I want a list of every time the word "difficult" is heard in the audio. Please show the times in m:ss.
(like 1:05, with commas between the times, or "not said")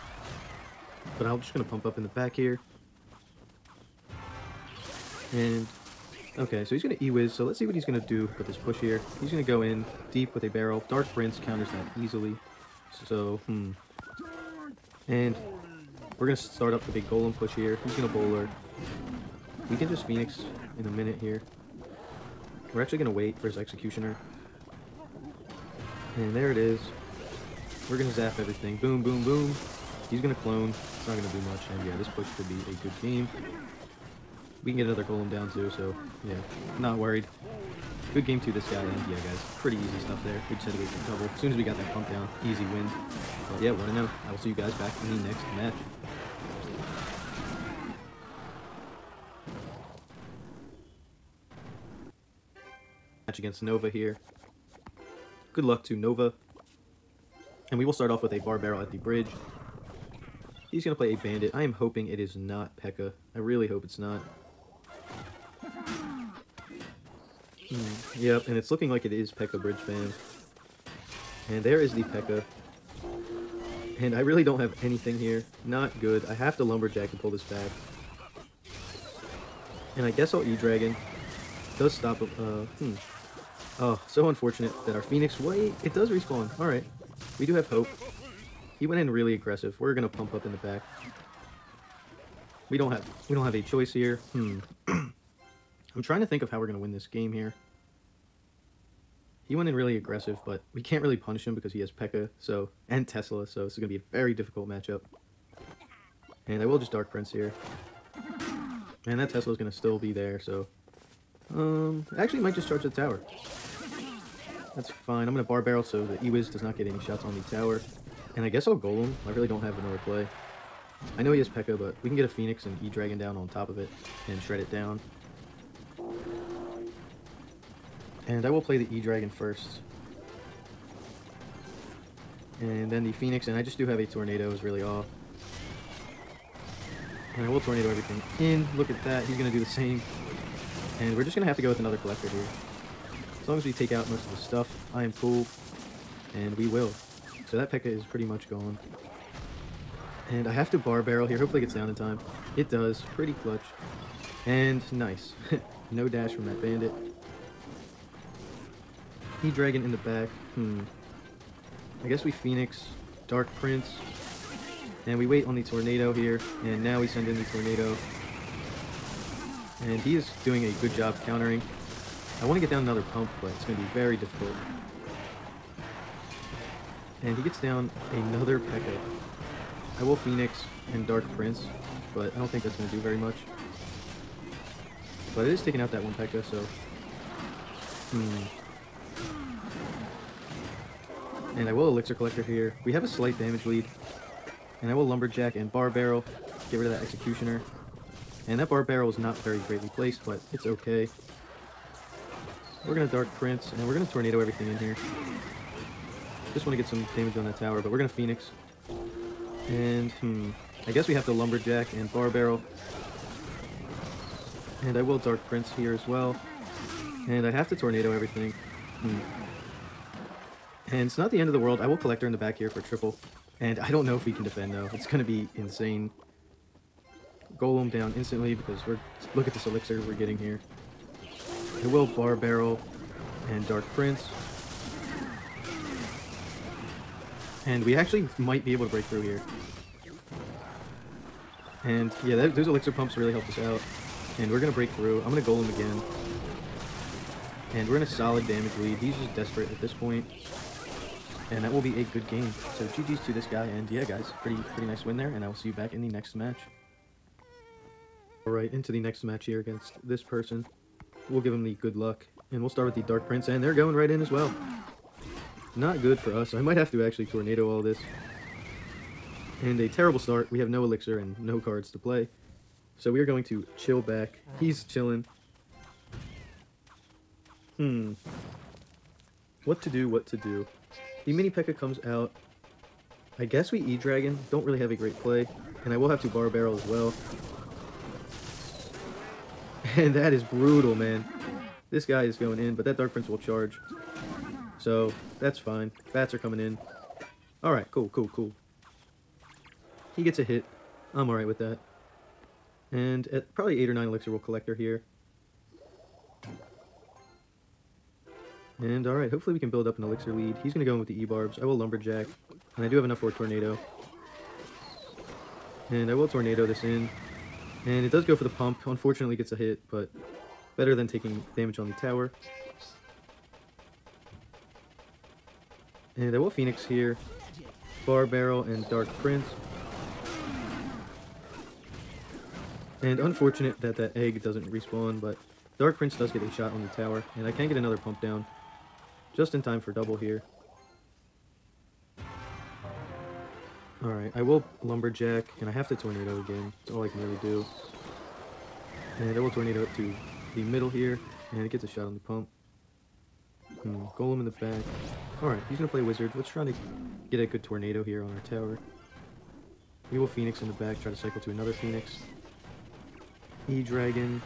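1:44, 2:54.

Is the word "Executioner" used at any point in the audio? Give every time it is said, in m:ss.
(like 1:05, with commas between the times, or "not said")
0:23, 3:17.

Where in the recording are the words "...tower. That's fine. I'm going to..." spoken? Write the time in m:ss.
1:52.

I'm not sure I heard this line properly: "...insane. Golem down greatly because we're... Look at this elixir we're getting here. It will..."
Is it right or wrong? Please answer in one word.
wrong.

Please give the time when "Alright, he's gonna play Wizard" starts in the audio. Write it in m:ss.
5:55.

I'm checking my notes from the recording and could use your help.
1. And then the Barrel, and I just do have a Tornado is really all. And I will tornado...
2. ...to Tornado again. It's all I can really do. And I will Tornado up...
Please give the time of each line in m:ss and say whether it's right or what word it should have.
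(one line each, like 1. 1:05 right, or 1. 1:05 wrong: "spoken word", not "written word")
1. 2:12 wrong: "Phoenix", not "Barrel"
2. 5:45 right.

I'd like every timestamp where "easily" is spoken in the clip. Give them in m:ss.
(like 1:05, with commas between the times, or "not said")
0:12.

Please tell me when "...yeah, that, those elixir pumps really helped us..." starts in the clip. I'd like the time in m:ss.
4:02.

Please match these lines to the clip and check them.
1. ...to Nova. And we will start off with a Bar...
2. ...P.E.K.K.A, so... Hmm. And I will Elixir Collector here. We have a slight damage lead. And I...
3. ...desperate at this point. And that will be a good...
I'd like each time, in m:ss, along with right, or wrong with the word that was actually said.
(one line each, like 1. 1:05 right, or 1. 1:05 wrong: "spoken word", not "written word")
1. 0:55 right
2. 3:06 right
3. 4:09 right.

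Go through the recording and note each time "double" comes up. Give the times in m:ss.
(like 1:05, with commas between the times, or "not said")
5:39.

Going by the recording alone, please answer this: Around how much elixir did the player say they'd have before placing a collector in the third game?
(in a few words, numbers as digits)
8 or 9.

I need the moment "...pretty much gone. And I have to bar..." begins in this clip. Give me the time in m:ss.
2:28.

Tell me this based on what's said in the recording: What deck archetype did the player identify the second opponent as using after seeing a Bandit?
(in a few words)
Pekka Bridge Spam.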